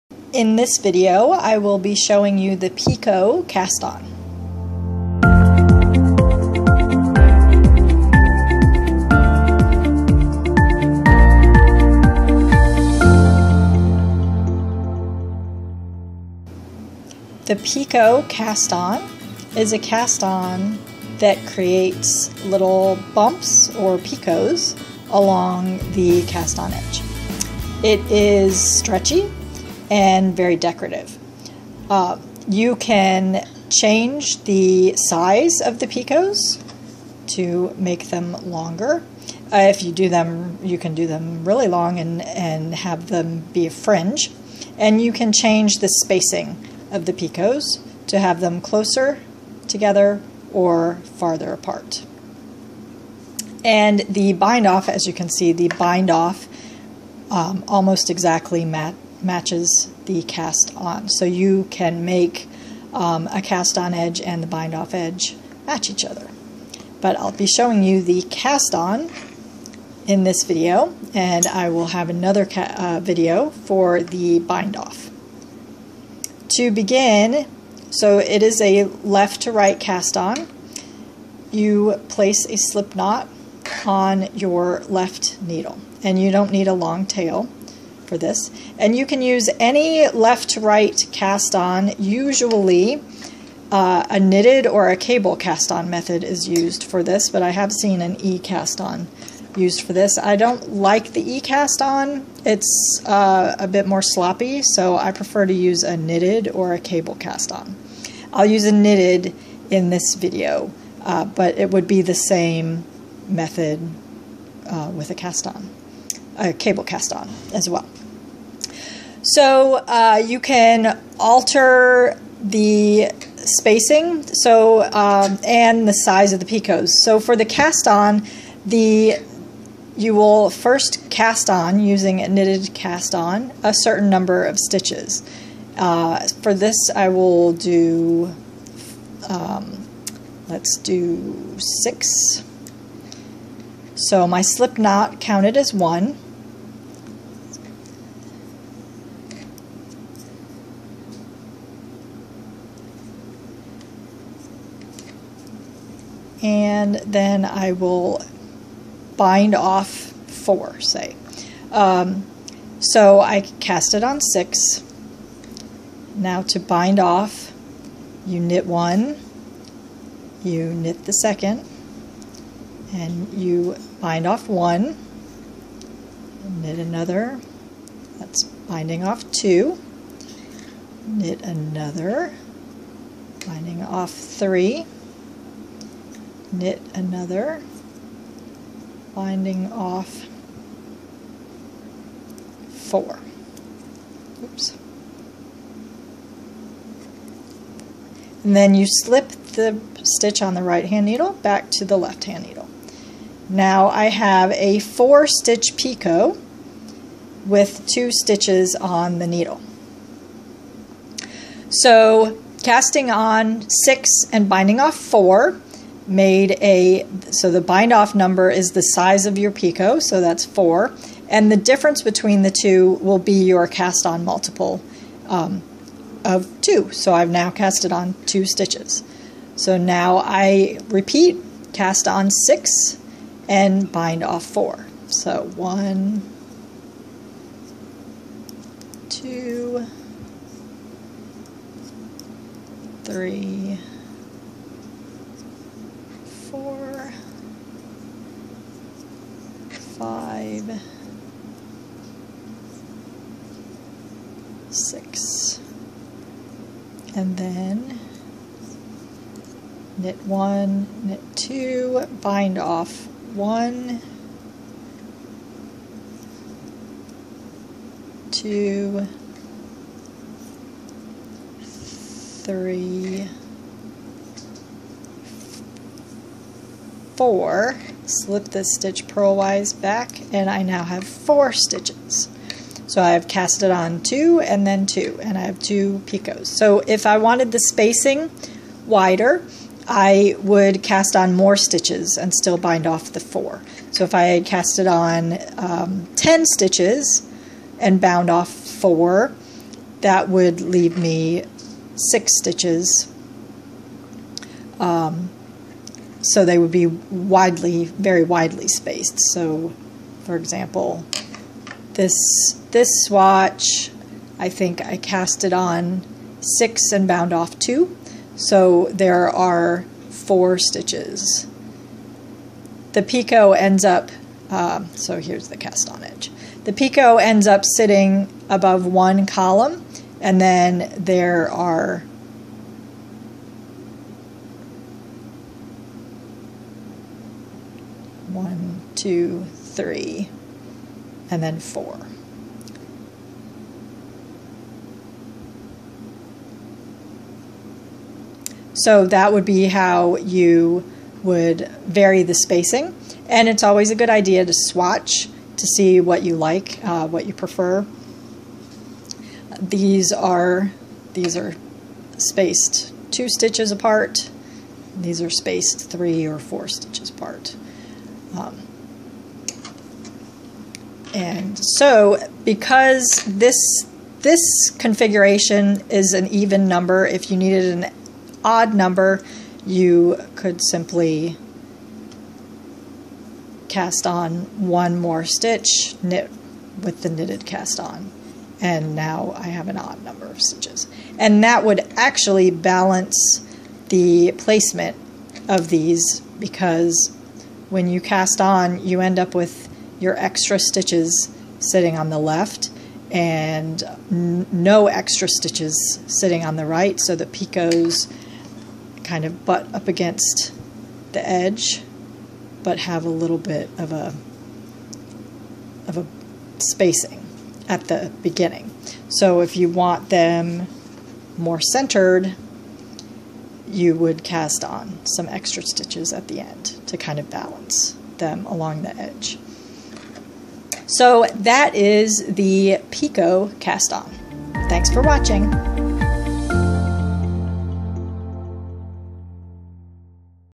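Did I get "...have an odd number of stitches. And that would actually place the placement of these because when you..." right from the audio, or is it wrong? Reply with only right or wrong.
wrong.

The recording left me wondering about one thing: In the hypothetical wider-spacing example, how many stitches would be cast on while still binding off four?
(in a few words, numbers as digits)
10.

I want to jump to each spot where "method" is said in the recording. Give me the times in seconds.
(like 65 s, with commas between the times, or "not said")
95 s, 113 s.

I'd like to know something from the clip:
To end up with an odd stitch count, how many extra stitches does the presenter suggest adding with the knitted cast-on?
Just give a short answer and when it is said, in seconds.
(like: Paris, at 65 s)
1, at 384 s.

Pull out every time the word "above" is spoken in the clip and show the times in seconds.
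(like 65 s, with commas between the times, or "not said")
328 s.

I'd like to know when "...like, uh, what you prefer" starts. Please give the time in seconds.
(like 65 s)
356 s.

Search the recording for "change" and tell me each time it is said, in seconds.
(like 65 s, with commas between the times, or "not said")
33 s, 45 s.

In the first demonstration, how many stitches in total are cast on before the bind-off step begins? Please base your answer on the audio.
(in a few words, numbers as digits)
6.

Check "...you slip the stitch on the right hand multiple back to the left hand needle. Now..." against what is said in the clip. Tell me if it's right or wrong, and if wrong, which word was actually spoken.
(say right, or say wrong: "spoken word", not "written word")
wrong: "needle", not "multiple".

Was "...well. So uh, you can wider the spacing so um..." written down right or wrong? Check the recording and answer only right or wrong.
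wrong.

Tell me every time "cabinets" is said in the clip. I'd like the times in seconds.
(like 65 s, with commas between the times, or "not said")
not said.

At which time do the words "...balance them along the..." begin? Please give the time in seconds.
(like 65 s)
427 s.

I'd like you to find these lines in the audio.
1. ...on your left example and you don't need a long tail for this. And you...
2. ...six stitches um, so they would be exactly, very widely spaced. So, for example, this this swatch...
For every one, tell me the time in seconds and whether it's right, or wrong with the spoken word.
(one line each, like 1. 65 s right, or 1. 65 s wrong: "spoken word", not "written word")
1. 83 s wrong: "needle", not "example"
2. 301 s wrong: "widely", not "exactly".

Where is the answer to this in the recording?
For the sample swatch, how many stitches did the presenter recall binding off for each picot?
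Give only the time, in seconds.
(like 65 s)
317 s.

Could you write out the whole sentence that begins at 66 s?
But I'll be showing you the cast on in this video and I will have another uh, video for the bind off.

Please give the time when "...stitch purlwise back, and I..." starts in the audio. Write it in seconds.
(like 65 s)
278 s.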